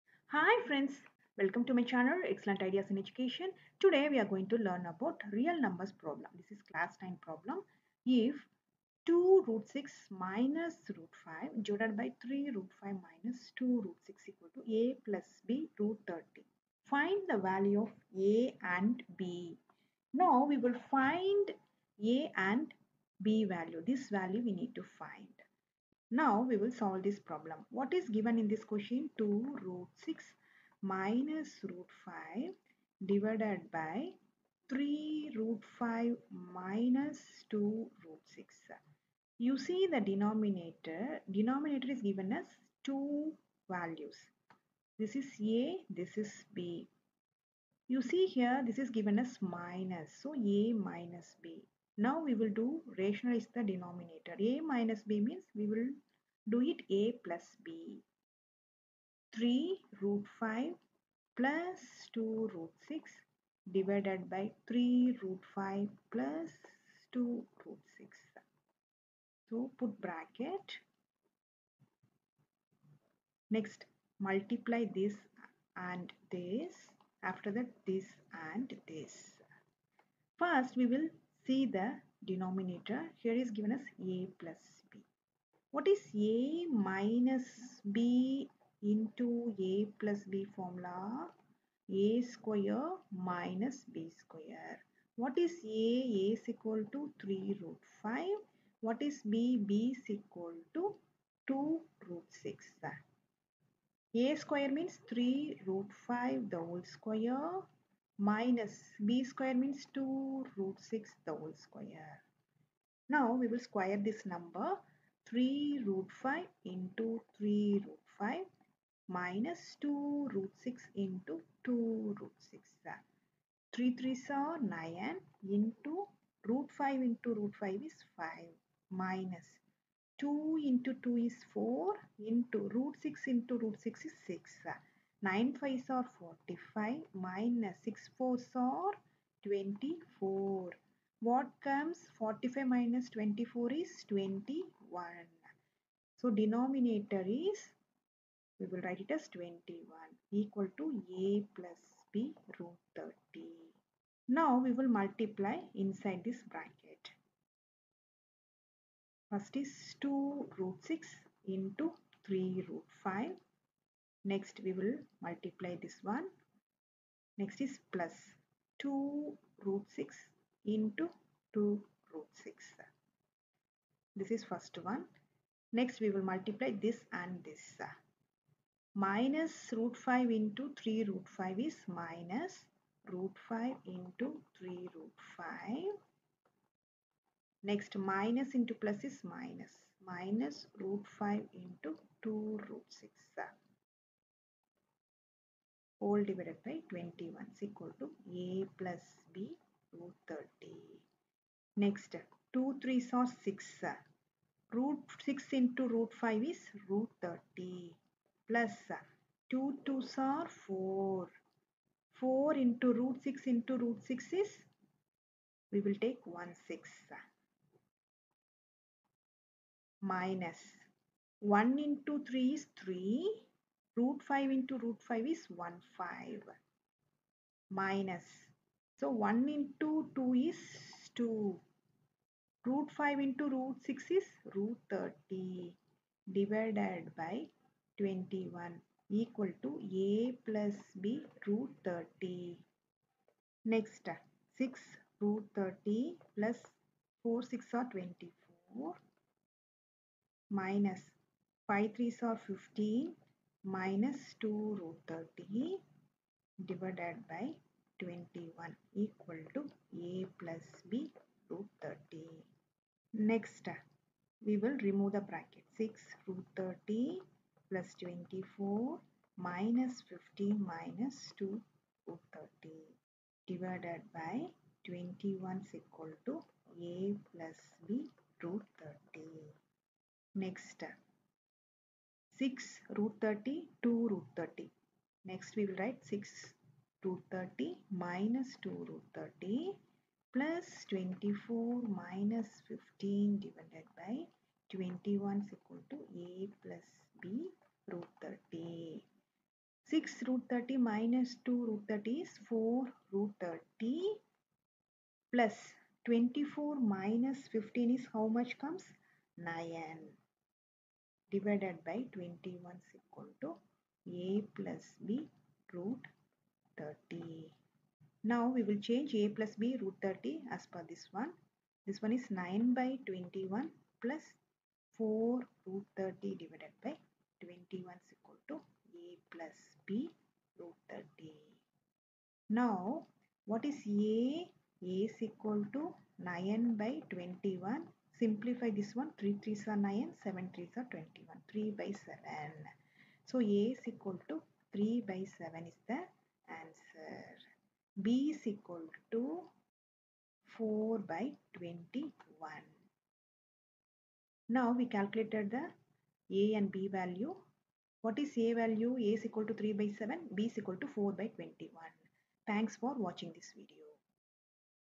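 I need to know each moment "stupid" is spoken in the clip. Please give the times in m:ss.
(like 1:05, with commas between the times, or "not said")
not said.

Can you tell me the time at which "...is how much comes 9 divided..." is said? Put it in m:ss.
5:07.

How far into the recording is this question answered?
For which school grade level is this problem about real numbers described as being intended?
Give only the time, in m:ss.
0:06.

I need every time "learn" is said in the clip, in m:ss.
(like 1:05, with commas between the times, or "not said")
0:04.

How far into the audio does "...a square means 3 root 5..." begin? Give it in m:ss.
1:44.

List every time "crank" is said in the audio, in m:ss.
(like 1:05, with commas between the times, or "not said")
not said.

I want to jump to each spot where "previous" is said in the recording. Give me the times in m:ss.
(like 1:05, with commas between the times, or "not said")
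not said.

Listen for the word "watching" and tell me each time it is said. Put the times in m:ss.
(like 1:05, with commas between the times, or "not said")
6:03.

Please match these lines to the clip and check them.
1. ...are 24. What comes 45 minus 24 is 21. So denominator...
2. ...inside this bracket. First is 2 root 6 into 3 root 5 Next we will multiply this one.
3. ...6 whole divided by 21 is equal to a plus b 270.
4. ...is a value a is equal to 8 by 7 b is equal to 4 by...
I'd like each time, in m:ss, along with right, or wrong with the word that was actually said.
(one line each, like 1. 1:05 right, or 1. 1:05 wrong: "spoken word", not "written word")
1. 2:18 right
2. 2:35 right
3. 3:12 wrong: "230", not "270"
4. 5:58 wrong: "3", not "8".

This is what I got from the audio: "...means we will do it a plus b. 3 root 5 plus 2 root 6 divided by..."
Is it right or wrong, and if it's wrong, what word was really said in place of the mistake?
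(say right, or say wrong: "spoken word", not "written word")
right.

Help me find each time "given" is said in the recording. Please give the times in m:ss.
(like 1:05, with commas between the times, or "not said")
0:28, 0:42, 0:48, 1:23.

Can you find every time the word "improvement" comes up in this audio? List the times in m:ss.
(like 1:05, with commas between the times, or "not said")
not said.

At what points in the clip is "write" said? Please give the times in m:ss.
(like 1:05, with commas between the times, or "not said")
2:28, 4:45.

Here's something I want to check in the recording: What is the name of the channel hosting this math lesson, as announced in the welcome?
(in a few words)
Excellent Ideas in Education.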